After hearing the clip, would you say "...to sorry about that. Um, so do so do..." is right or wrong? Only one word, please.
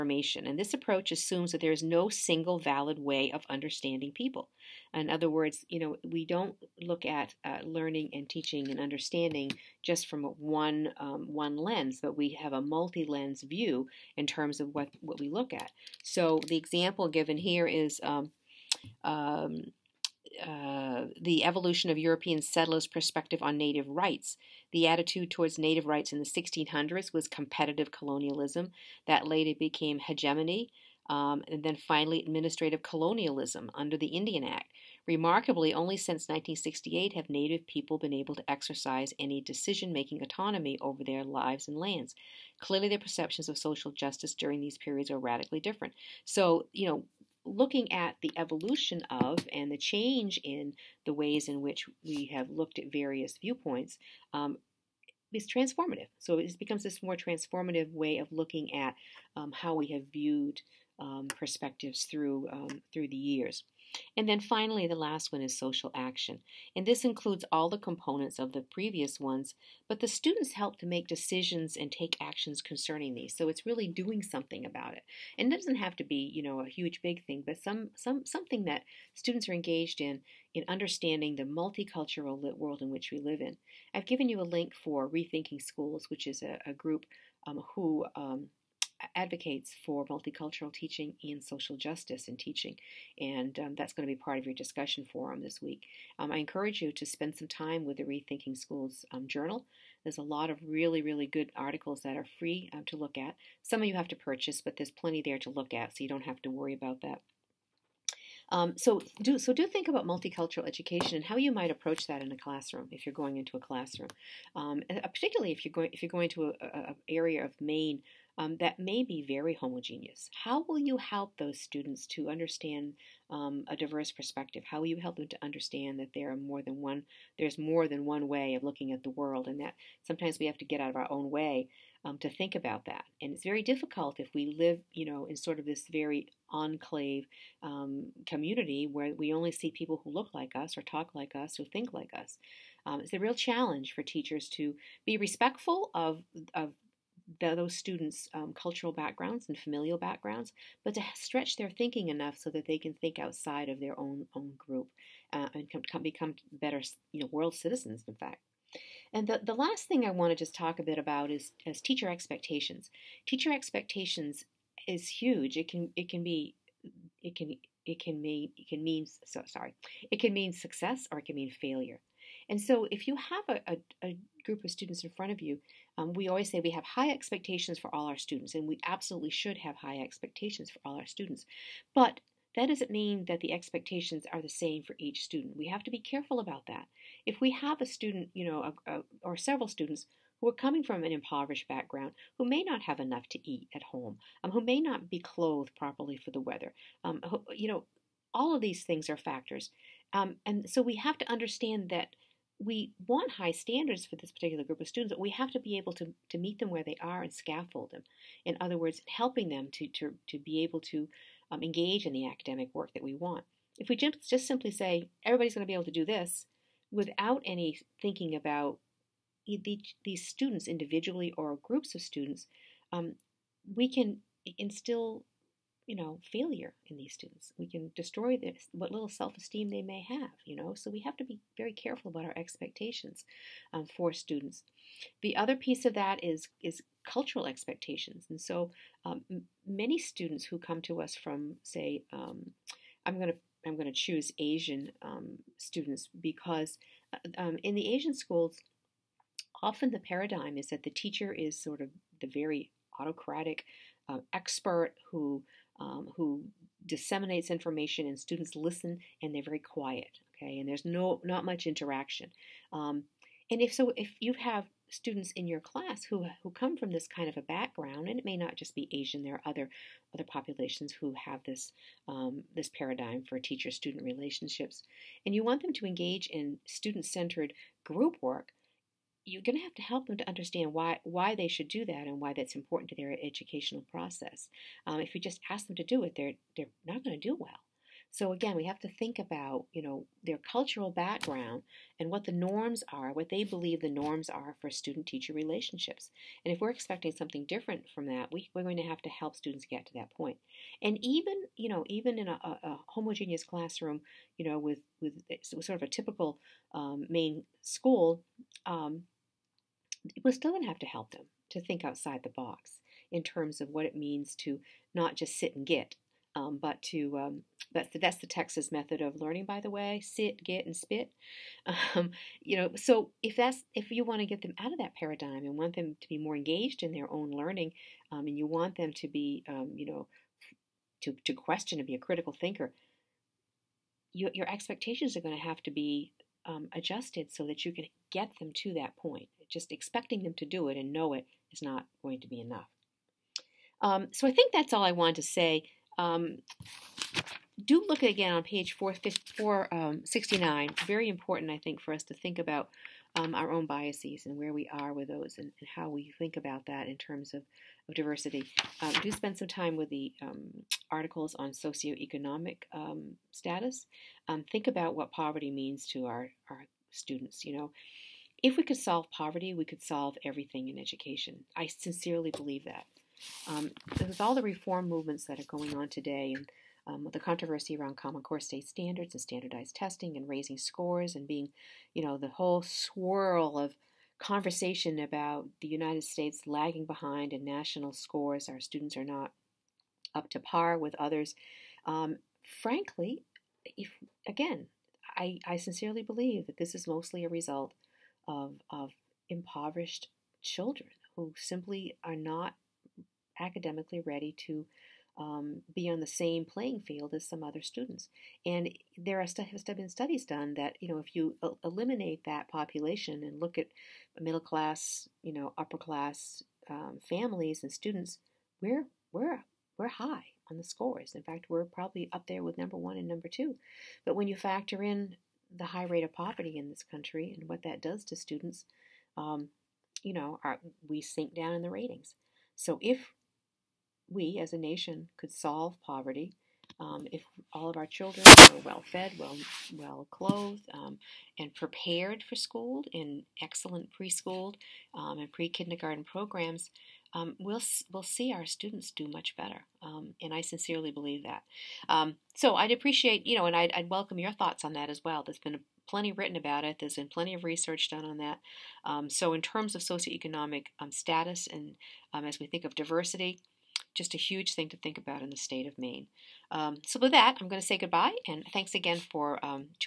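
wrong.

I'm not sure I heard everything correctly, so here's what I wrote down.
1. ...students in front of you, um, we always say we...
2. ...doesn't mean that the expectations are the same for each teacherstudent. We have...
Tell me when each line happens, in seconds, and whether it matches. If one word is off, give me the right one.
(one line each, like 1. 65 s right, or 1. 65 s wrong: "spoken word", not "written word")
1. 174 s right
2. 182 s wrong: "student", not "teacherstudent".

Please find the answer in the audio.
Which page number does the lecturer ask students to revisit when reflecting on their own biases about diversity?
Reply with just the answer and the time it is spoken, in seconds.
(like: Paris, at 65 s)
469, at 348 s.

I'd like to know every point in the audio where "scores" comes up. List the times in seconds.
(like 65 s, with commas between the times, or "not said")
380 s, 387 s, 420 s.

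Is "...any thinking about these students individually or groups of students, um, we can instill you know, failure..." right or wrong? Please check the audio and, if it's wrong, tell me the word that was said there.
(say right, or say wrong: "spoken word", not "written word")
right.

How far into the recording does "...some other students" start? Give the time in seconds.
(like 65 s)
407 s.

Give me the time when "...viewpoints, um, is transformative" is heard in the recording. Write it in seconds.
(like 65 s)
53 s.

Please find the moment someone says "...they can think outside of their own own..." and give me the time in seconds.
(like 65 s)
152 s.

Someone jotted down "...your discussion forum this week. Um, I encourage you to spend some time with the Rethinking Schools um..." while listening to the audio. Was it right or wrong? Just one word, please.
right.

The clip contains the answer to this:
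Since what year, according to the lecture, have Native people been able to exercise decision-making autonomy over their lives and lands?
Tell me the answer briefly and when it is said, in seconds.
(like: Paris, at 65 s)
1968, at 36 s.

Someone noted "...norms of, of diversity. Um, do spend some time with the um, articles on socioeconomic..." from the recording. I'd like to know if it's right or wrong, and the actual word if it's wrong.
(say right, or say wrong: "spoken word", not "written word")
wrong: "terms", not "norms".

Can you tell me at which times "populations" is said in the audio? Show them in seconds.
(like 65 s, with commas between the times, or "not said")
270 s, 412 s.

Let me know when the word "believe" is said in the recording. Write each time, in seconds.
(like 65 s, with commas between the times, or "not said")
293 s, 372 s, 396 s, 450 s.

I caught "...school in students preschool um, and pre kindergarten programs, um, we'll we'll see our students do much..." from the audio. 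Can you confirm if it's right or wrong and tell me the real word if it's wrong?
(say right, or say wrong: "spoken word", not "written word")
wrong: "excellent", not "students".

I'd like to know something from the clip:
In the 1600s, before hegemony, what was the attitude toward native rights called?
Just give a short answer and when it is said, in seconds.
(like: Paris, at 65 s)
competitive colonialism, at 27 s.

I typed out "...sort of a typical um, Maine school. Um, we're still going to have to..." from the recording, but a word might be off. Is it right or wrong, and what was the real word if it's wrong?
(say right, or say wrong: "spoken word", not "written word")
right.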